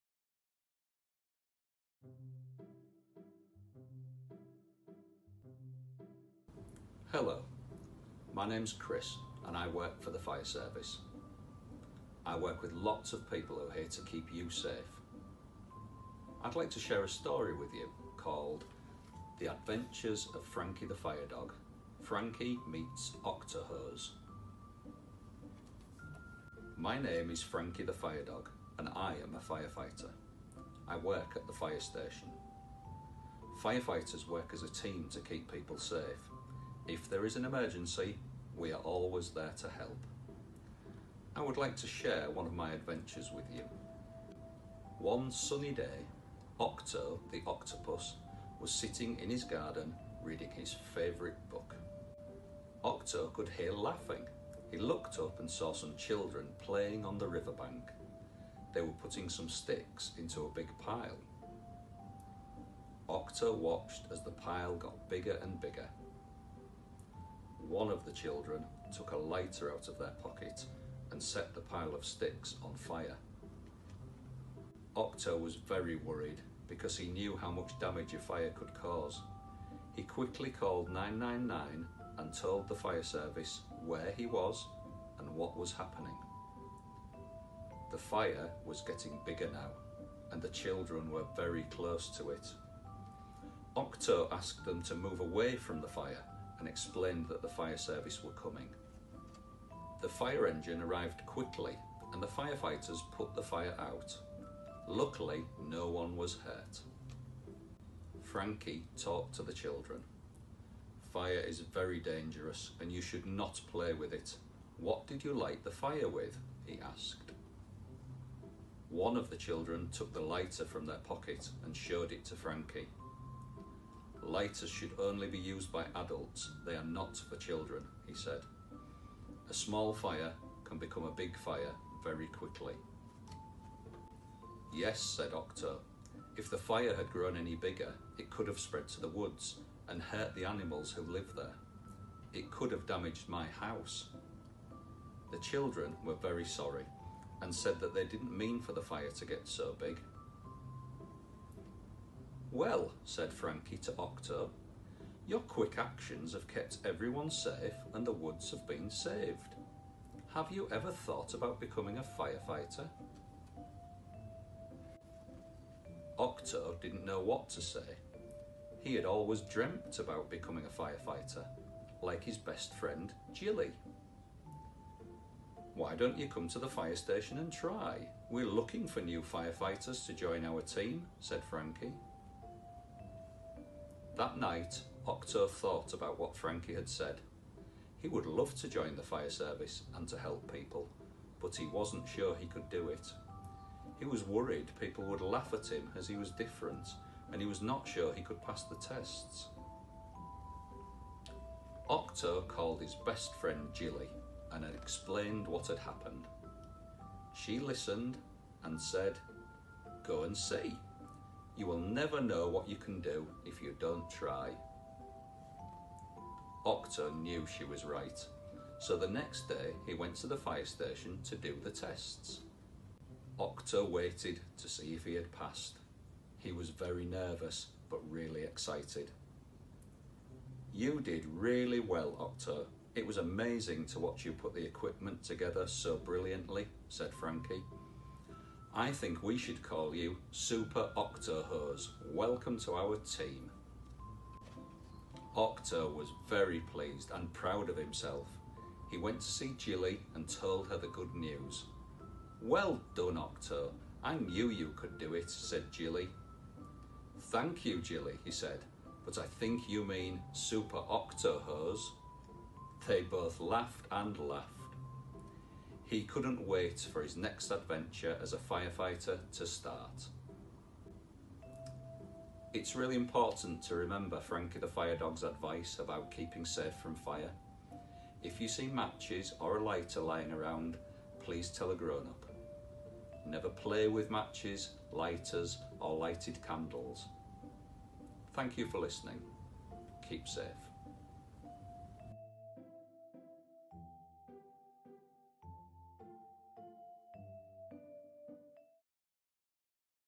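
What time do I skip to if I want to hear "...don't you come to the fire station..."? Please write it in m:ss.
2:55.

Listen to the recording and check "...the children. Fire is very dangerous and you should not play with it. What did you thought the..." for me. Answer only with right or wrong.
wrong.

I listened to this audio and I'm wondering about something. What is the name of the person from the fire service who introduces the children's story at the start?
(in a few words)
Chris.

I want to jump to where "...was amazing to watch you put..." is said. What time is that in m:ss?
3:53.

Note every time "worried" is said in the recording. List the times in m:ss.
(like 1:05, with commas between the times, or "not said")
1:15, 3:14.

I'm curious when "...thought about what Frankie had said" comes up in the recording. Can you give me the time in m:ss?
3:05.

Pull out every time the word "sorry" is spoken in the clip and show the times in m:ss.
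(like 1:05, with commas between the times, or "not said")
2:26.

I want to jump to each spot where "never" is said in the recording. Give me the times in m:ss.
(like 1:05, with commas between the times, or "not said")
3:31, 4:43.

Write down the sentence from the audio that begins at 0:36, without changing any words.
If there is an emergency, we are always there to help.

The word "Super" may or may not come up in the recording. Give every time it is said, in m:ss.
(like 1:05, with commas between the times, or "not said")
4:00, 4:20.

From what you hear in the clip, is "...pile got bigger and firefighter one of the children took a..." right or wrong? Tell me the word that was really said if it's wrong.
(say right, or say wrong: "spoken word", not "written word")
wrong: "bigger", not "firefighter".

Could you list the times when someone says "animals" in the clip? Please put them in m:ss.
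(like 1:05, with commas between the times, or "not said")
2:20.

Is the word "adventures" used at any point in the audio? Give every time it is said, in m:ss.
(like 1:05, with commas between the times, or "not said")
0:19, 0:42, 4:27.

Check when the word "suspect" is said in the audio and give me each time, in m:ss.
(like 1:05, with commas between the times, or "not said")
not said.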